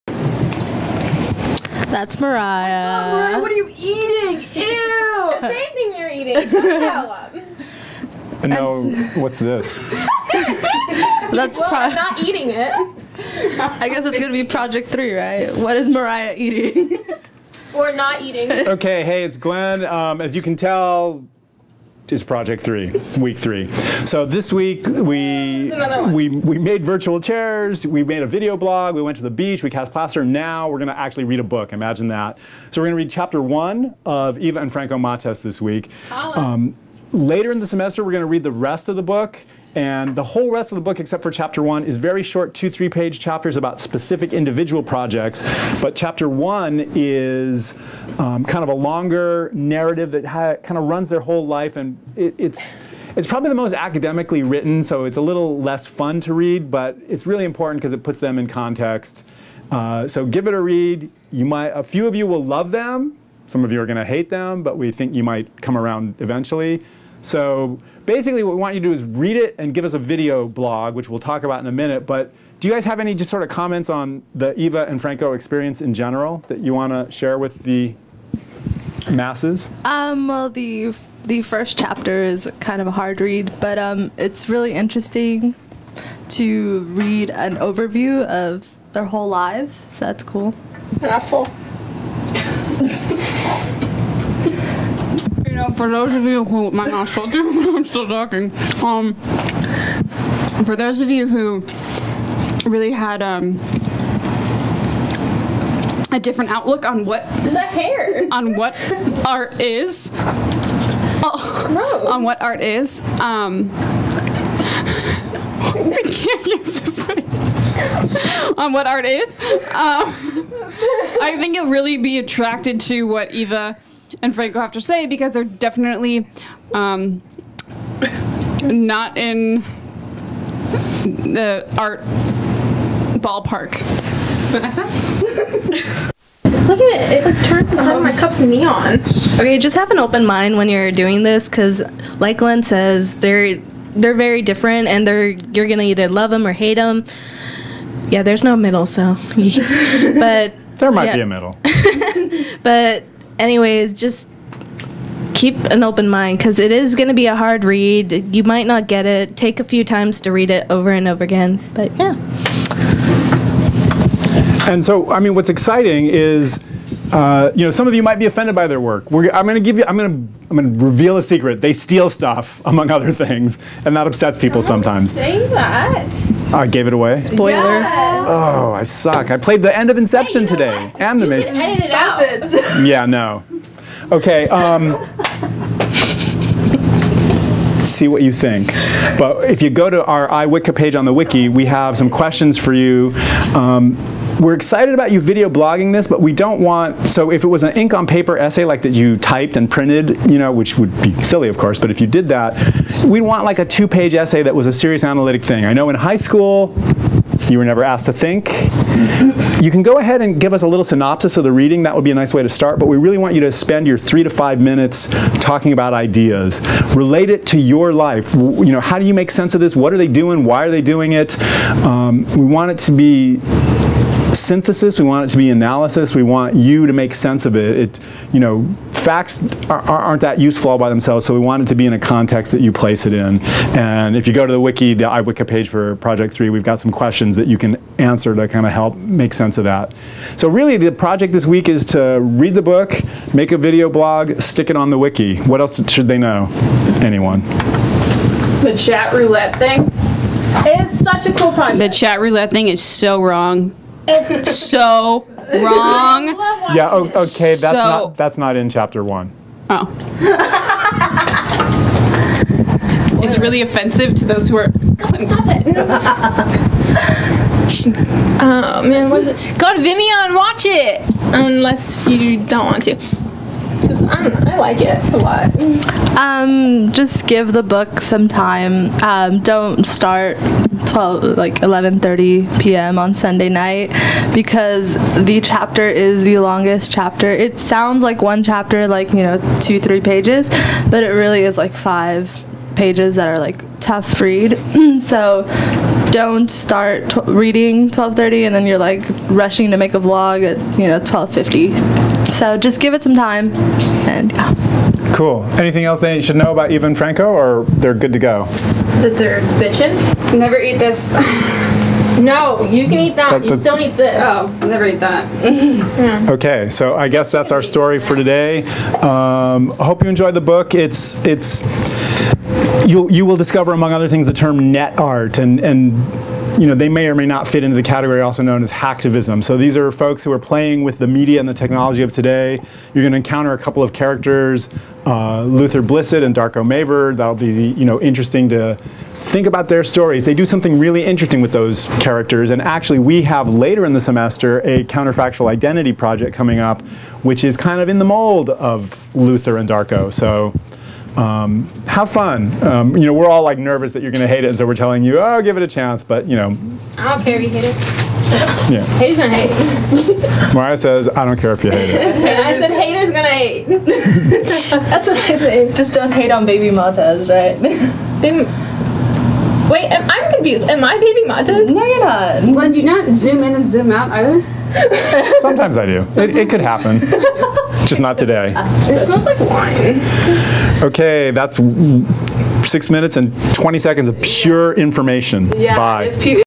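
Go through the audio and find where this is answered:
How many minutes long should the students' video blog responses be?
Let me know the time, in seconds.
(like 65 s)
213 s.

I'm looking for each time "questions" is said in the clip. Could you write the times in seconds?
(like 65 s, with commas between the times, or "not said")
192 s, 236 s.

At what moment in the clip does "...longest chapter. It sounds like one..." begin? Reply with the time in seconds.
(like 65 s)
286 s.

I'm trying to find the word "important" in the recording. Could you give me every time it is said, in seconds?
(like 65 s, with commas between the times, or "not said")
57 s.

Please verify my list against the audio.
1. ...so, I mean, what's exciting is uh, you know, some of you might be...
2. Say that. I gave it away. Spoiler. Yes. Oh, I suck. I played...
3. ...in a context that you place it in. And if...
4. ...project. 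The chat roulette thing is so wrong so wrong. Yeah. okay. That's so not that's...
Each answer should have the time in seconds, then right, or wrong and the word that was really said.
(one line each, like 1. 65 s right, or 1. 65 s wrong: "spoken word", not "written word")
1. 164 s right
2. 175 s right
3. 231 s right
4. 251 s right.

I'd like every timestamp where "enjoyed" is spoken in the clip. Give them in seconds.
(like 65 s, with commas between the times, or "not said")
320 s.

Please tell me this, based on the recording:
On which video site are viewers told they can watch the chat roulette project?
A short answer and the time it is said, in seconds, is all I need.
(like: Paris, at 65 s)
Vimeo, at 269 s.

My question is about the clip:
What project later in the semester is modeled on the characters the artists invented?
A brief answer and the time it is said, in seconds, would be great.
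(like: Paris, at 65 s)
counterfactual identity project, at 344 s.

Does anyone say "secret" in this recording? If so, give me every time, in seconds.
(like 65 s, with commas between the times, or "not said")
171 s.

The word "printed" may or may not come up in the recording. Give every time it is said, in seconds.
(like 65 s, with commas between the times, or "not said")
199 s.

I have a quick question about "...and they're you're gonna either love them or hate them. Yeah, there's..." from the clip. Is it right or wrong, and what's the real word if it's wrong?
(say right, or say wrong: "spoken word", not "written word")
right.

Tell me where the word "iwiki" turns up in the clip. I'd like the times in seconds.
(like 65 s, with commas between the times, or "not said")
190 s, 235 s.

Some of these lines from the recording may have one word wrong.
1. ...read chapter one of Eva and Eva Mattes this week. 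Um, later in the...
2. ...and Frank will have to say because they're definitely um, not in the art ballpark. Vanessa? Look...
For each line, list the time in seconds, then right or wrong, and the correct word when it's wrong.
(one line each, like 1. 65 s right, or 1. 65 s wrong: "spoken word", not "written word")
1. 33 s wrong: "Franco", not "Eva"
2. 124 s right.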